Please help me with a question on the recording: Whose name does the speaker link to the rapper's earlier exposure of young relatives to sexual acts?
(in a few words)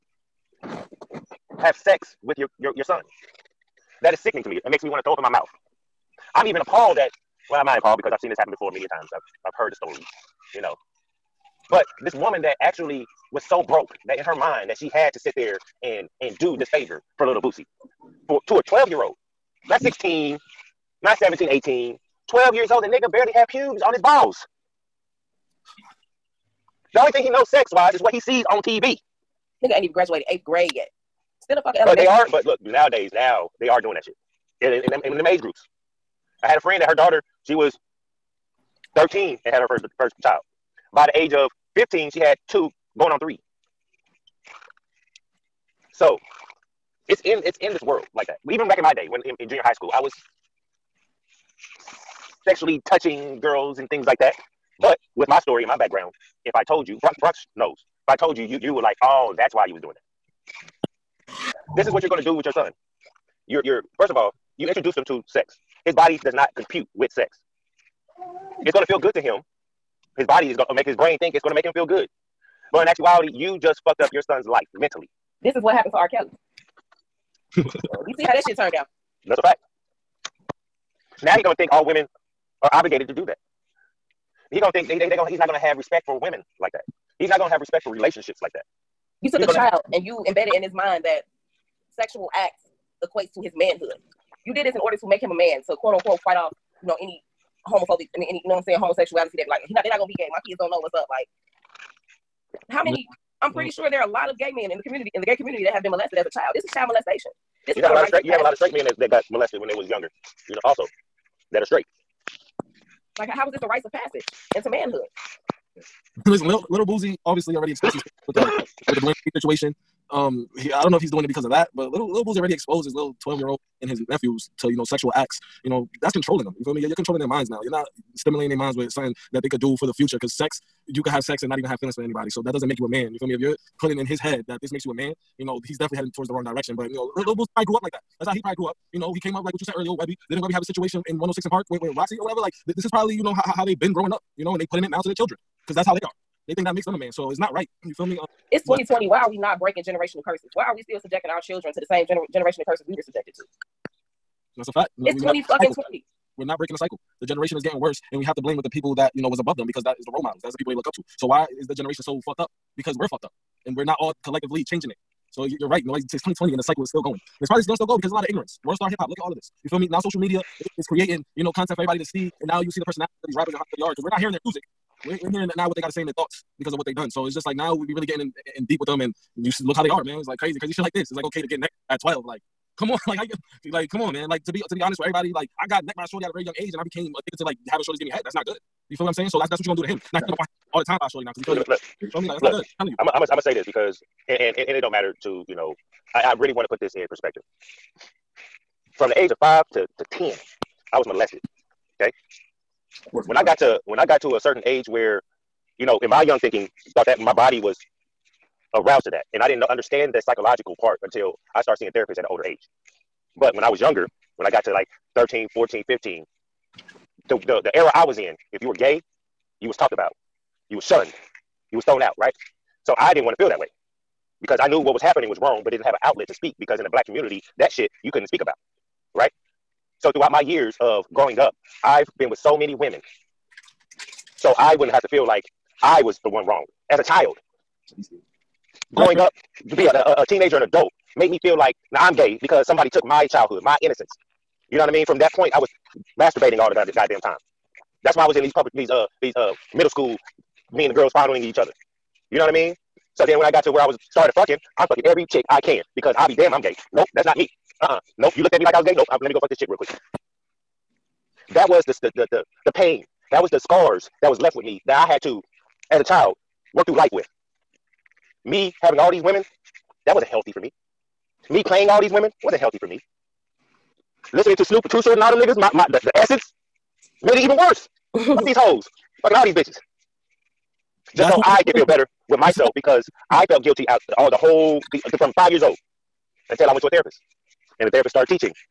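Dwayne.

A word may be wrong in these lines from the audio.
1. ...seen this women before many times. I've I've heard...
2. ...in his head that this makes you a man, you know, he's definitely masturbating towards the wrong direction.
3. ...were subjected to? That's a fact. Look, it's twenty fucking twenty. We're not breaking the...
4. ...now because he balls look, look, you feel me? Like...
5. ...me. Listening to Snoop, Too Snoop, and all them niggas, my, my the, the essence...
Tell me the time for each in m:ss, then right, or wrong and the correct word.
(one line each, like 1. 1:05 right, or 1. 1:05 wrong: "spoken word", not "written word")
1. 0:08 wrong: "happen", not "women"
2. 2:13 wrong: "heading", not "masturbating"
3. 2:32 right
4. 3:11 wrong: "feels", not "balls"
5. 4:32 wrong: "Short", not "Snoop".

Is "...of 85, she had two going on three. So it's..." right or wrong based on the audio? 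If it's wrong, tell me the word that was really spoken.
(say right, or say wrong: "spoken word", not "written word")
wrong: "15", not "85".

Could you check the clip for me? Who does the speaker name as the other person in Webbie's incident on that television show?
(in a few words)
Rocsi.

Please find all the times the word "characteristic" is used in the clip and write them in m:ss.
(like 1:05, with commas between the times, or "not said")
not said.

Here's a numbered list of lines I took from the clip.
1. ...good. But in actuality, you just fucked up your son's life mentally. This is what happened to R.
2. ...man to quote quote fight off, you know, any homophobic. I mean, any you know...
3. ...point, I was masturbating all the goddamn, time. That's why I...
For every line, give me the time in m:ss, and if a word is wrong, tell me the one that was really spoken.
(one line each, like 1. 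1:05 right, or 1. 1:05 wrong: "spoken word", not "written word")
1. 1:11 right
2. 1:35 wrong: "unquote", not "quote"
3. 4:05 right.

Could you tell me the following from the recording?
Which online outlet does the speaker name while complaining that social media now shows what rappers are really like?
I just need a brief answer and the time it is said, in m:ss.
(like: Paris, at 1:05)
World Star Hip Hop, at 2:48.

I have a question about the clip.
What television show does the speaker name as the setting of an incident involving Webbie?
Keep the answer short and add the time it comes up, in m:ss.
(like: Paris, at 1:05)
106 and Park, at 2:21.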